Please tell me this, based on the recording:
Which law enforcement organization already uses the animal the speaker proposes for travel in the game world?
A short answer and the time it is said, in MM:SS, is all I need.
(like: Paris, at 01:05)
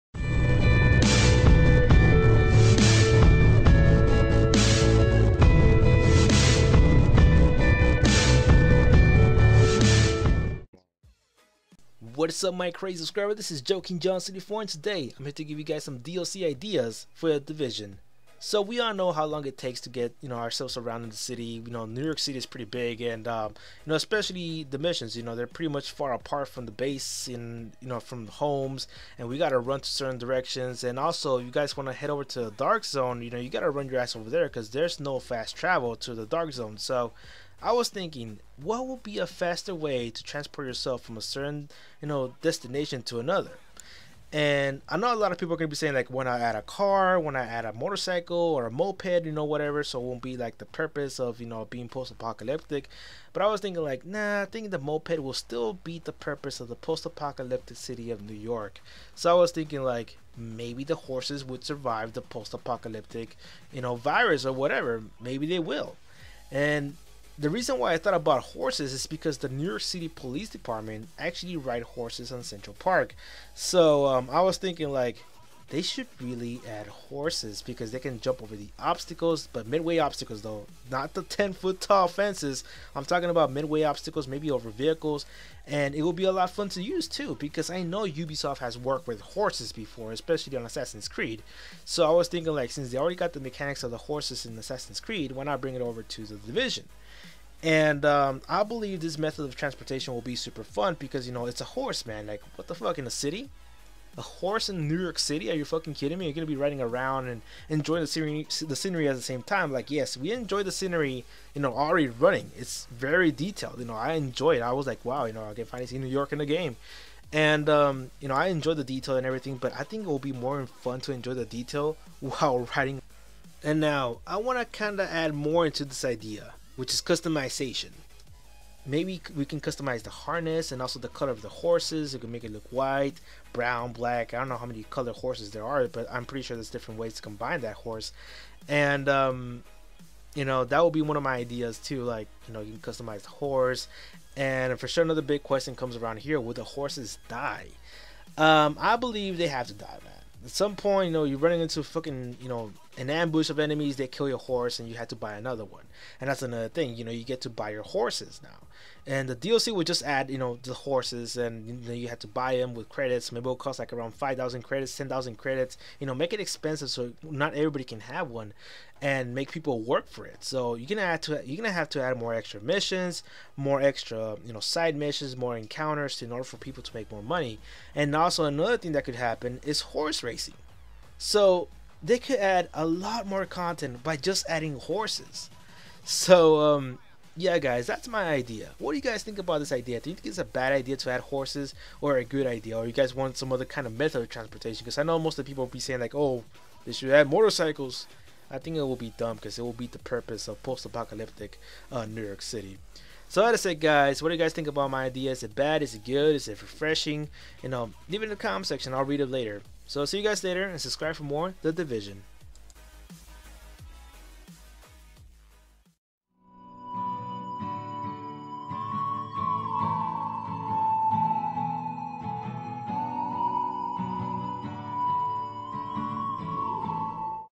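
New York City Police Department, at 01:09.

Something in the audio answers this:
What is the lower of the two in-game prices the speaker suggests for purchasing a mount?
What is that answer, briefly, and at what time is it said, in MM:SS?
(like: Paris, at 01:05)
5,000 credits, at 02:44.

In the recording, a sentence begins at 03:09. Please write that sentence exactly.
Do you think it's a bad idea to add horses or a good idea?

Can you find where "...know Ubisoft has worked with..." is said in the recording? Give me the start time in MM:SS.
01:27.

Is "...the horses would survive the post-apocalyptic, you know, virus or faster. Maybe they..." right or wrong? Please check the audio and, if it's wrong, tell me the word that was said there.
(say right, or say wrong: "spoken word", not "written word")
wrong: "whatever", not "faster".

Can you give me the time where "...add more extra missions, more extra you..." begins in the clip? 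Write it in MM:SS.
02:52.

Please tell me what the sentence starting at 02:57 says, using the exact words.
And also another thing that could happen is horse racing.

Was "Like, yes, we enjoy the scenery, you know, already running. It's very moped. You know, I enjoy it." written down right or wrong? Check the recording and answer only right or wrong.
wrong.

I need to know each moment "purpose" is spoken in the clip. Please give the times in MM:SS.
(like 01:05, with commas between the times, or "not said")
00:50, 00:56, 03:19.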